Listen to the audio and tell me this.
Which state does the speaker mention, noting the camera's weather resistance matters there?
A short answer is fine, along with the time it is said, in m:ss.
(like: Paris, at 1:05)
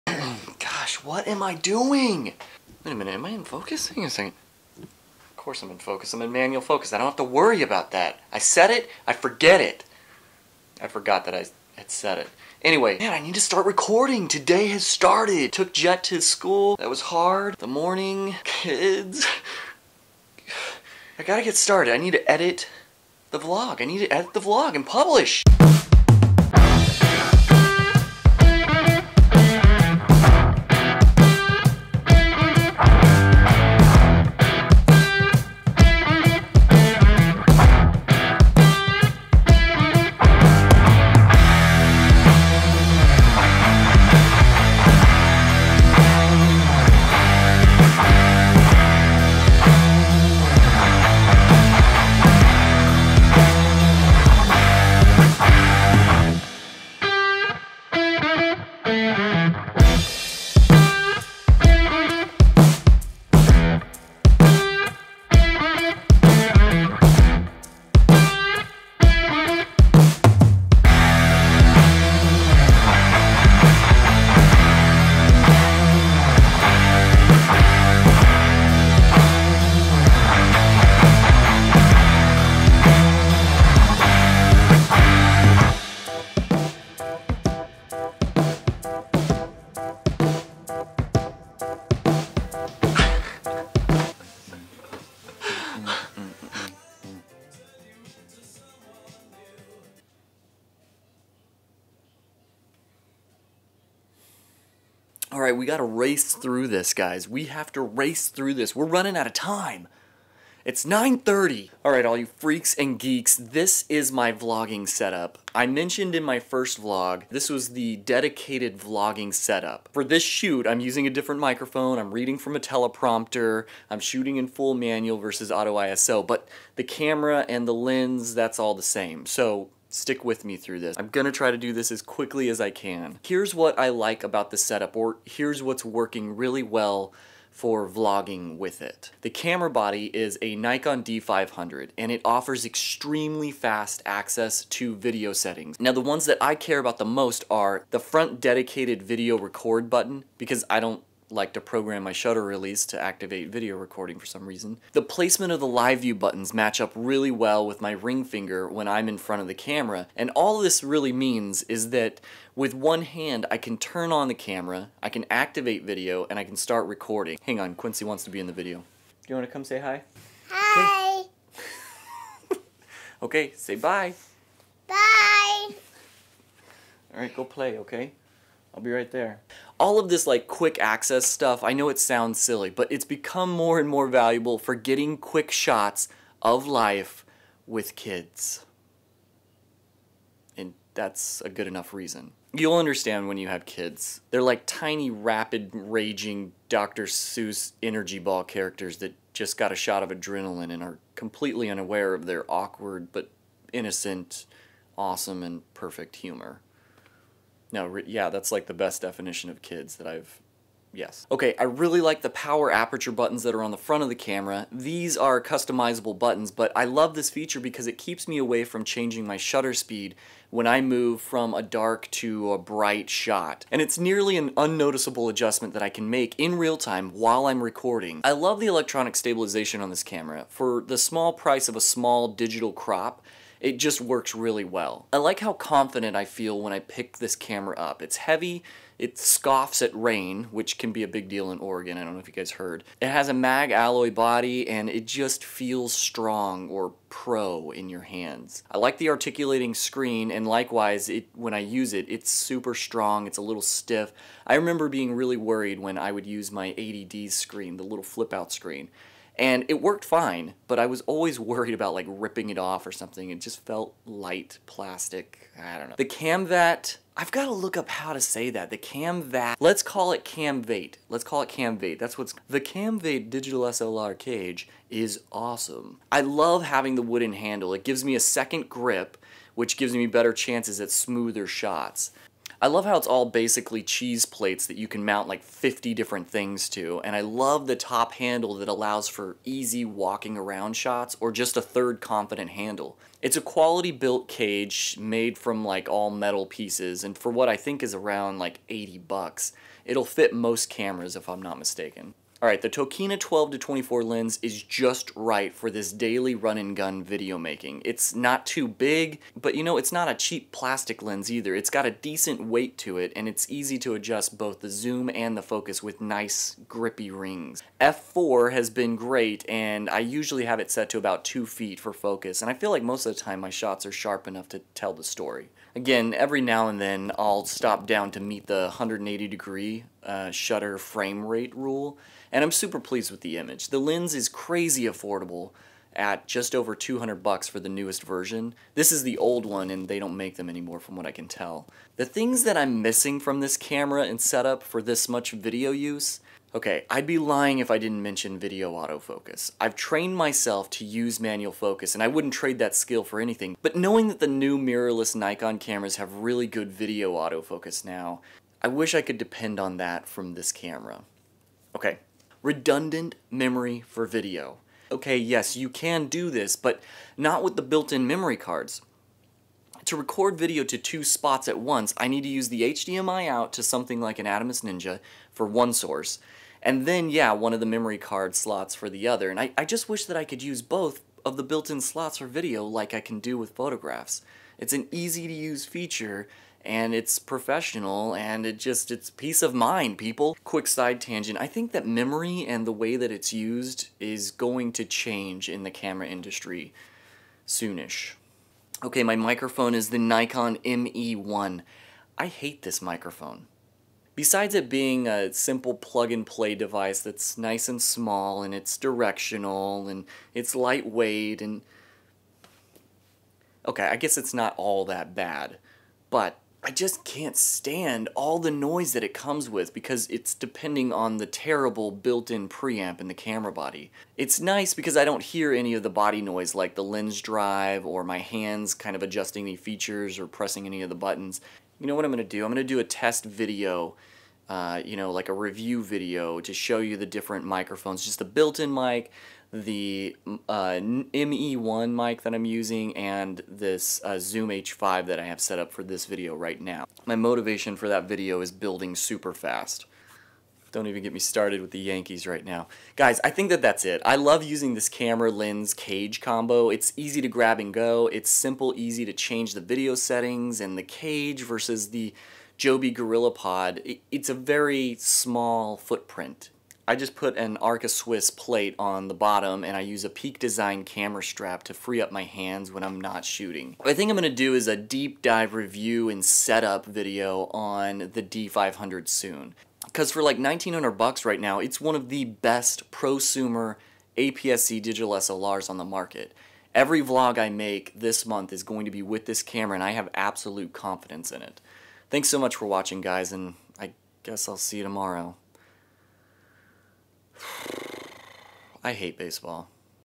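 Oregon, at 4:01.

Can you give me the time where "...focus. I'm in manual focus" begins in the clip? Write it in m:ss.
0:05.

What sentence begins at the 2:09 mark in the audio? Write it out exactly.
So Stick with me through this.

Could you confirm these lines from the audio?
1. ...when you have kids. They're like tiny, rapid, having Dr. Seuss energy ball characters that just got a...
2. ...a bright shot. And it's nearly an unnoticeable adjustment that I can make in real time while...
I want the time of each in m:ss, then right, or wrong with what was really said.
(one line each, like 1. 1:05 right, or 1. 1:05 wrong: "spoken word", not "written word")
1. 3:13 wrong: "raging", not "having"
2. 3:42 right.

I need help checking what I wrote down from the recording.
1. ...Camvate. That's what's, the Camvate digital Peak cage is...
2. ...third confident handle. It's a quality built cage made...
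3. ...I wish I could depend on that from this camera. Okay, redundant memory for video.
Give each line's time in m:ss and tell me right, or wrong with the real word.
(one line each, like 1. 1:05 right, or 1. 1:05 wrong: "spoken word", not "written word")
1. 4:31 wrong: "SLR", not "Peak"
2. 4:51 right
3. 5:58 right.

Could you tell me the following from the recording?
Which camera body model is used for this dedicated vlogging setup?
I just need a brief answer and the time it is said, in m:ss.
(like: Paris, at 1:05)
Nikon D500, at 2:20.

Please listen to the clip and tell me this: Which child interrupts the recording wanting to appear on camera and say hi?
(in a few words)
Quincy.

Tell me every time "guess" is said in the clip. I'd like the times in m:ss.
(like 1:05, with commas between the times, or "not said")
6:53, 8:14.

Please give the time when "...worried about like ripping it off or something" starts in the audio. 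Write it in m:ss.
4:21.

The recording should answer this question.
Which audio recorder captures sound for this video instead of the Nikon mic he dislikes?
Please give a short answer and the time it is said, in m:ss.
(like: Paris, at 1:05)
Zoom H5, at 7:24.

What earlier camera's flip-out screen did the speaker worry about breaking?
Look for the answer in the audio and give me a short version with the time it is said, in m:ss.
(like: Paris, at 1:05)
80D, at 4:16.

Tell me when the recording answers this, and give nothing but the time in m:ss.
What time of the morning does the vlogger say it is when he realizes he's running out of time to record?
1:50.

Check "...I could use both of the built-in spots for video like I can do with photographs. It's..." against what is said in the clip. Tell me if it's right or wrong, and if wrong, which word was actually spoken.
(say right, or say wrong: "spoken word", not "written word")
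wrong: "slots", not "spots".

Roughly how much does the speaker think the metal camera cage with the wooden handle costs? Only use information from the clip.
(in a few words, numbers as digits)
$80.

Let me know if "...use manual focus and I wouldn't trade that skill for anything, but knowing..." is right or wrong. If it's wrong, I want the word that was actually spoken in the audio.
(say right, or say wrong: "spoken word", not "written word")
right.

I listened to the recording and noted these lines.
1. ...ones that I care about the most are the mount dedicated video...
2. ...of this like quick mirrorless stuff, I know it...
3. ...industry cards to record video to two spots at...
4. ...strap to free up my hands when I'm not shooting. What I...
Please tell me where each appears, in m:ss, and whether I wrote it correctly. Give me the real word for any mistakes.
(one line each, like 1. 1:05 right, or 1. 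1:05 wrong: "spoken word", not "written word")
1. 2:25 wrong: "front", not "mount"
2. 2:59 wrong: "access", not "mirrorless"
3. 6:08 wrong: "memory", not "industry"
4. 7:51 right.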